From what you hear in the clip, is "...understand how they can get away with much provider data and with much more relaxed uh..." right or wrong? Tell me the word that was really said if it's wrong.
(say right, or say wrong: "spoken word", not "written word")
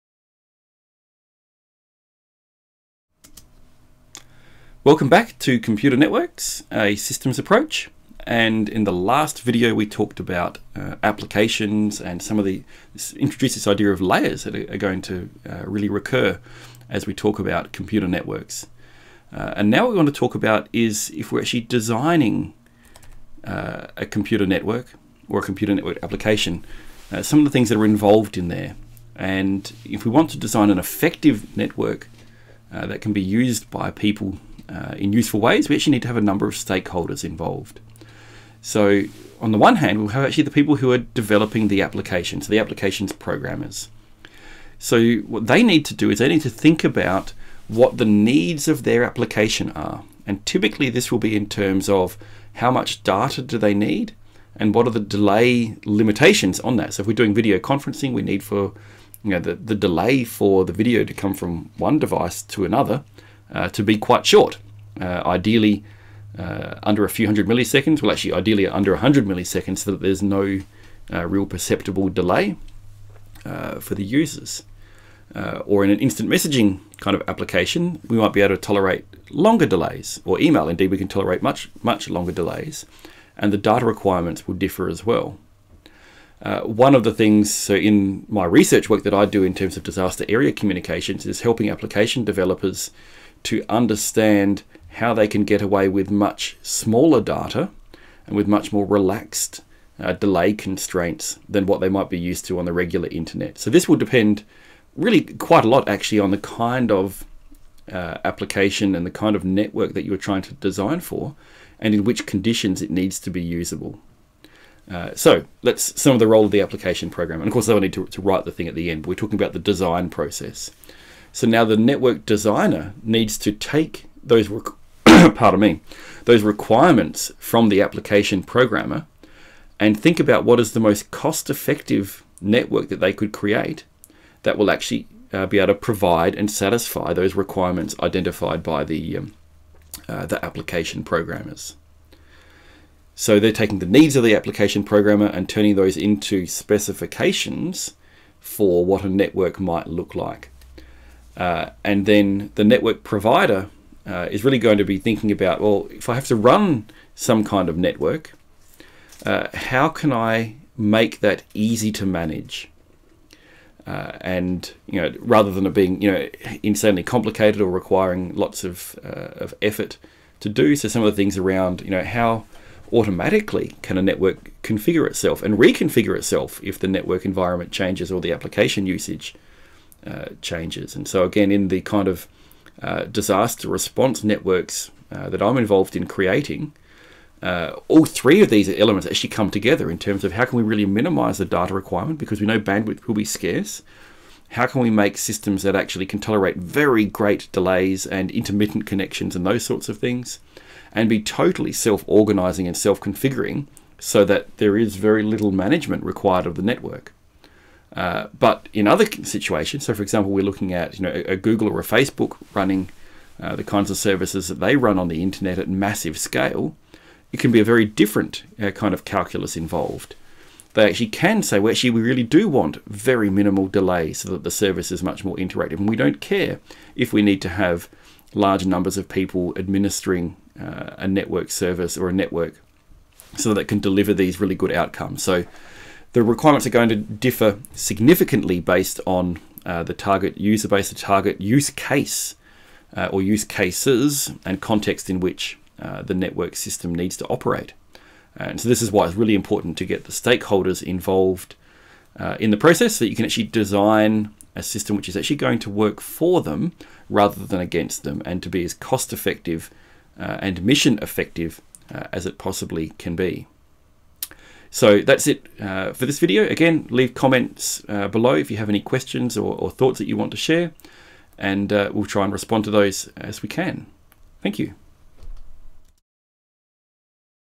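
wrong: "smaller", not "provider".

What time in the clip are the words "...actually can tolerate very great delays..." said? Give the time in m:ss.
3:15.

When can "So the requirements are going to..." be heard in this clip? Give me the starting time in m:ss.
3:55.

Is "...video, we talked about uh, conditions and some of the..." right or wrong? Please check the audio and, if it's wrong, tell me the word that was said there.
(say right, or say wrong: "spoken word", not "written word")
wrong: "applications", not "conditions".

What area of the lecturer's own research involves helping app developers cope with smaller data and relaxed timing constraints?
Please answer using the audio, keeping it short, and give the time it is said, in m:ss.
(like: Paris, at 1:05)
Disaster area communications, at 1:29.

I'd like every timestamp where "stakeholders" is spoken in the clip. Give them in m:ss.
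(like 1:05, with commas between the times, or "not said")
0:36, 4:10.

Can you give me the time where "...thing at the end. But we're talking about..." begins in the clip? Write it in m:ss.
1:58.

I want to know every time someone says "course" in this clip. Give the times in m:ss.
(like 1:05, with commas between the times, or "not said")
1:57.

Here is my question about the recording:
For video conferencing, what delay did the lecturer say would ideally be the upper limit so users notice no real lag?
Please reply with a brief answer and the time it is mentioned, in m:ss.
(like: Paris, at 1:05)
100 milliseconds, at 1:08.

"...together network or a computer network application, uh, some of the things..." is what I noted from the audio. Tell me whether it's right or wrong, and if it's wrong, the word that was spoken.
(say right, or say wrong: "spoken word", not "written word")
wrong: "computer", not "together".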